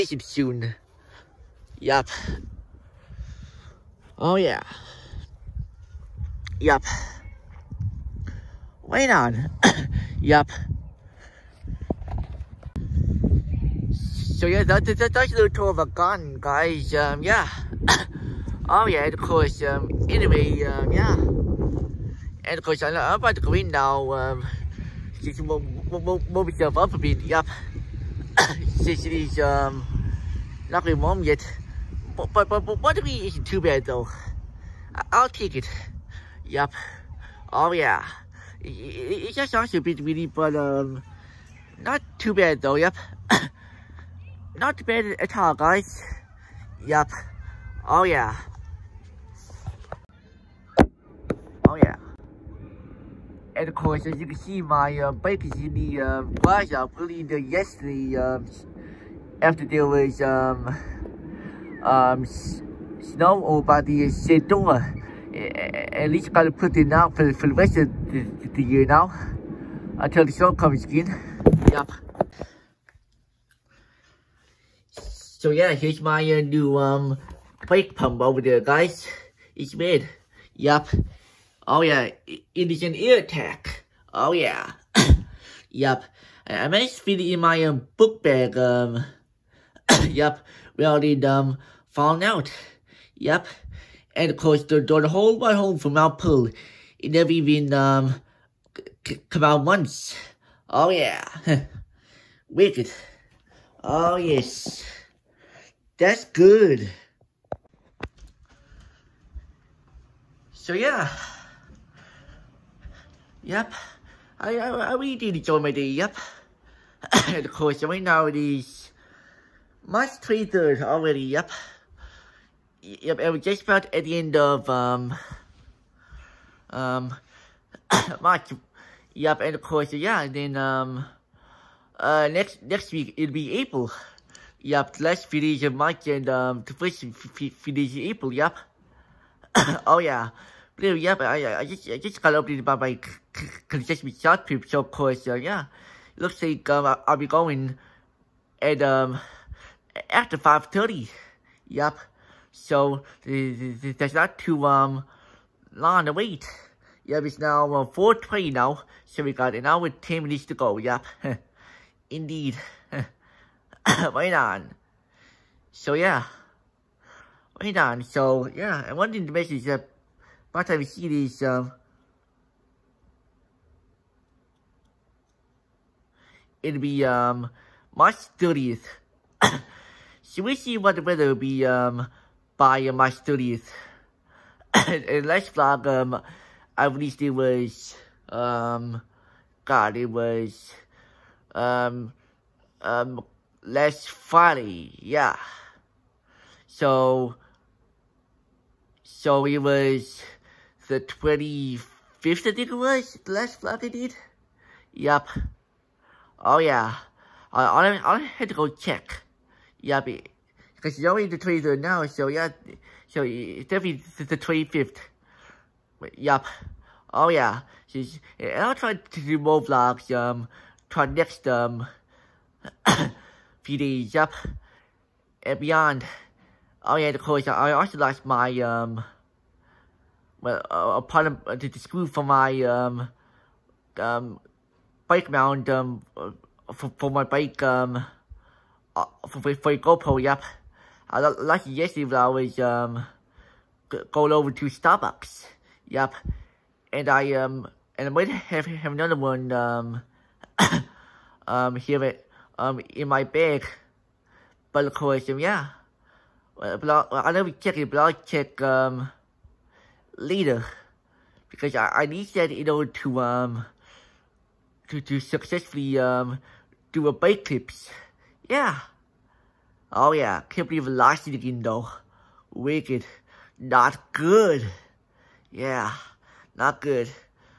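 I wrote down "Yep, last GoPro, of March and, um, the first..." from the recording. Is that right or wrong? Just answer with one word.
wrong.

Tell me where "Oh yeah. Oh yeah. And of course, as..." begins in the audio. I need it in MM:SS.
00:47.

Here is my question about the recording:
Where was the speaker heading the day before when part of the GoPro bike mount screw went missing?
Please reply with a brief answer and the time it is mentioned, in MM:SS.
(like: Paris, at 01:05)
Starbucks, at 04:04.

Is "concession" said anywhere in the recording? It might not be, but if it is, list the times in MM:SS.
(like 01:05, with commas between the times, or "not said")
02:23.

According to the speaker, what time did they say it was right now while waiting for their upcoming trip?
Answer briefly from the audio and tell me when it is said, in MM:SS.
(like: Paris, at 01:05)
4:20, at 02:37.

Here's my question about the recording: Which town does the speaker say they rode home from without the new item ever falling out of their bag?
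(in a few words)
Mount Pearl.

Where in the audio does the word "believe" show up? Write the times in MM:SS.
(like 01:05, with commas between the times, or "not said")
04:30.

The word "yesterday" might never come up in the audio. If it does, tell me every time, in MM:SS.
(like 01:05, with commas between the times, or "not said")
00:57, 04:01.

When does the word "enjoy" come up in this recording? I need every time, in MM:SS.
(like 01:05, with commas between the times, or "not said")
01:55.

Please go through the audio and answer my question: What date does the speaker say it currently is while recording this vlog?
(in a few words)
March 23rd.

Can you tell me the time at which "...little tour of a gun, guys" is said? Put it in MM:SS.
00:15.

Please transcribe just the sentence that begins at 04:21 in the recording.
Because I, I need that in order to um to to successfully um do a bike clips.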